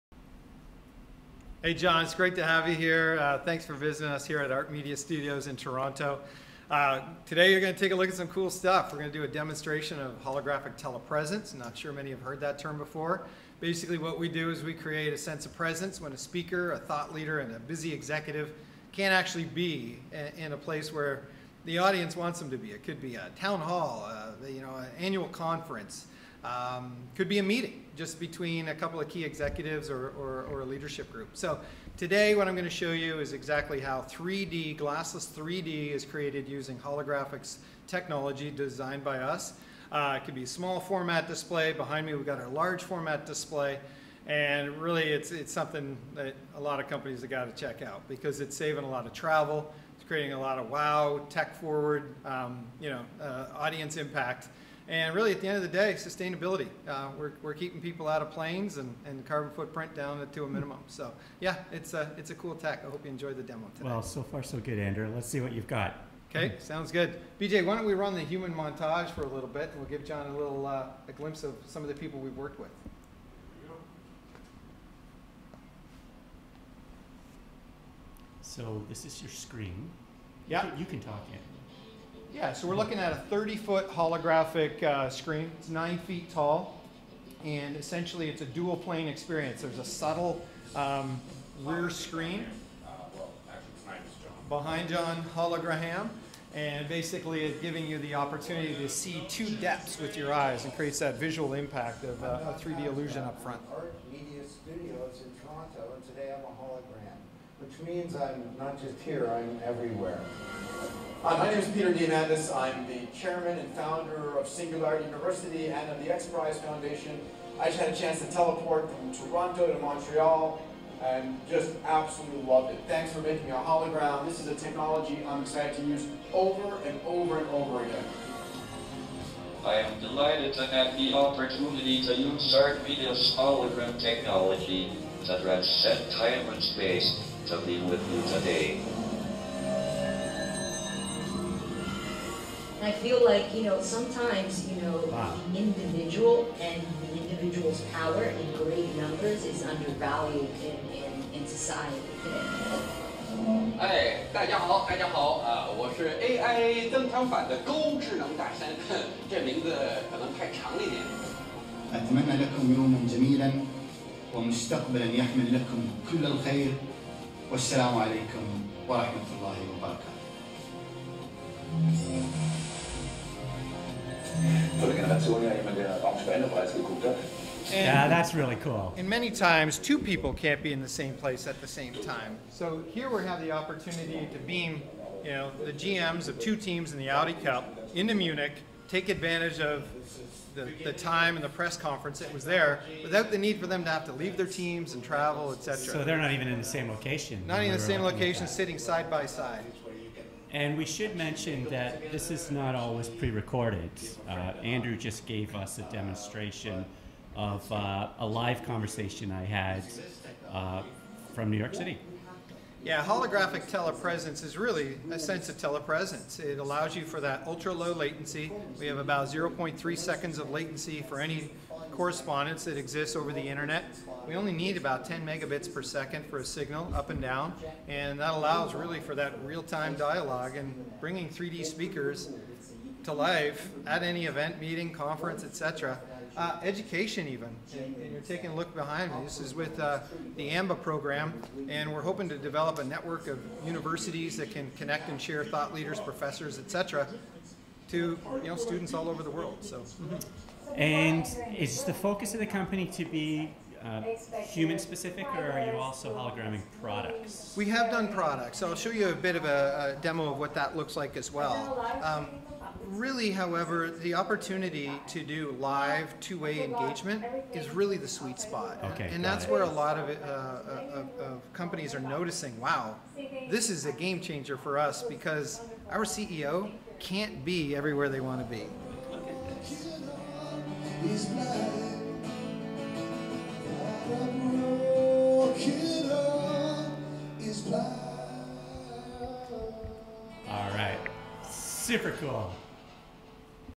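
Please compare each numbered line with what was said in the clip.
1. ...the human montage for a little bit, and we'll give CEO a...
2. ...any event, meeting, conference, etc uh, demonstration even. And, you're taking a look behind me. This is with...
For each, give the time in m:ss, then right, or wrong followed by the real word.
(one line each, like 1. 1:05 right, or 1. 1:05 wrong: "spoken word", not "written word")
1. 1:08 wrong: "John", not "CEO"
2. 3:54 wrong: "education", not "demonstration".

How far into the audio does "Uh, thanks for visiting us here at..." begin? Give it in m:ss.
0:03.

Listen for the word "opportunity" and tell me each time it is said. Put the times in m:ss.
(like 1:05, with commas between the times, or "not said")
1:38, 2:11, 3:03, 4:24.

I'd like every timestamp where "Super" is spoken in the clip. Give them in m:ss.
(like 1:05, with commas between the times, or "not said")
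4:51.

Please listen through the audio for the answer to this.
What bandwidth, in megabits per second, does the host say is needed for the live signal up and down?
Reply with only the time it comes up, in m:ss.
3:45.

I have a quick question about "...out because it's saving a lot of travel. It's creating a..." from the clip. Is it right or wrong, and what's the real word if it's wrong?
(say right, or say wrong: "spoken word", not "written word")
right.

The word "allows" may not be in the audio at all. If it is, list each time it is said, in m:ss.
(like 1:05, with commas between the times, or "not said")
3:36, 3:48.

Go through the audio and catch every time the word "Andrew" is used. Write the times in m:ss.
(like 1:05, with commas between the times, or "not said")
1:04, 3:24.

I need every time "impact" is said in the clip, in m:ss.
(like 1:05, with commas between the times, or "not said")
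0:53, 1:41.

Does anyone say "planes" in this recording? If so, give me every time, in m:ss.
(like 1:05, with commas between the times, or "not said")
0:58, 1:28.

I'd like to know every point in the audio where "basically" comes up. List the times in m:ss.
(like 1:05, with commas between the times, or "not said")
0:13, 1:36.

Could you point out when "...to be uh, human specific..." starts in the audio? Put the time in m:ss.
4:12.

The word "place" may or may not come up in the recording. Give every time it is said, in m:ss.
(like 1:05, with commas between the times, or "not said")
0:20, 3:01.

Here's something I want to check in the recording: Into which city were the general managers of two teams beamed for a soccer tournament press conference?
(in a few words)
Munich.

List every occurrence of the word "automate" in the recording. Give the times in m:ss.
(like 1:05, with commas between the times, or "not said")
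not said.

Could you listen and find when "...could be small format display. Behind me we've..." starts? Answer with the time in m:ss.
0:40.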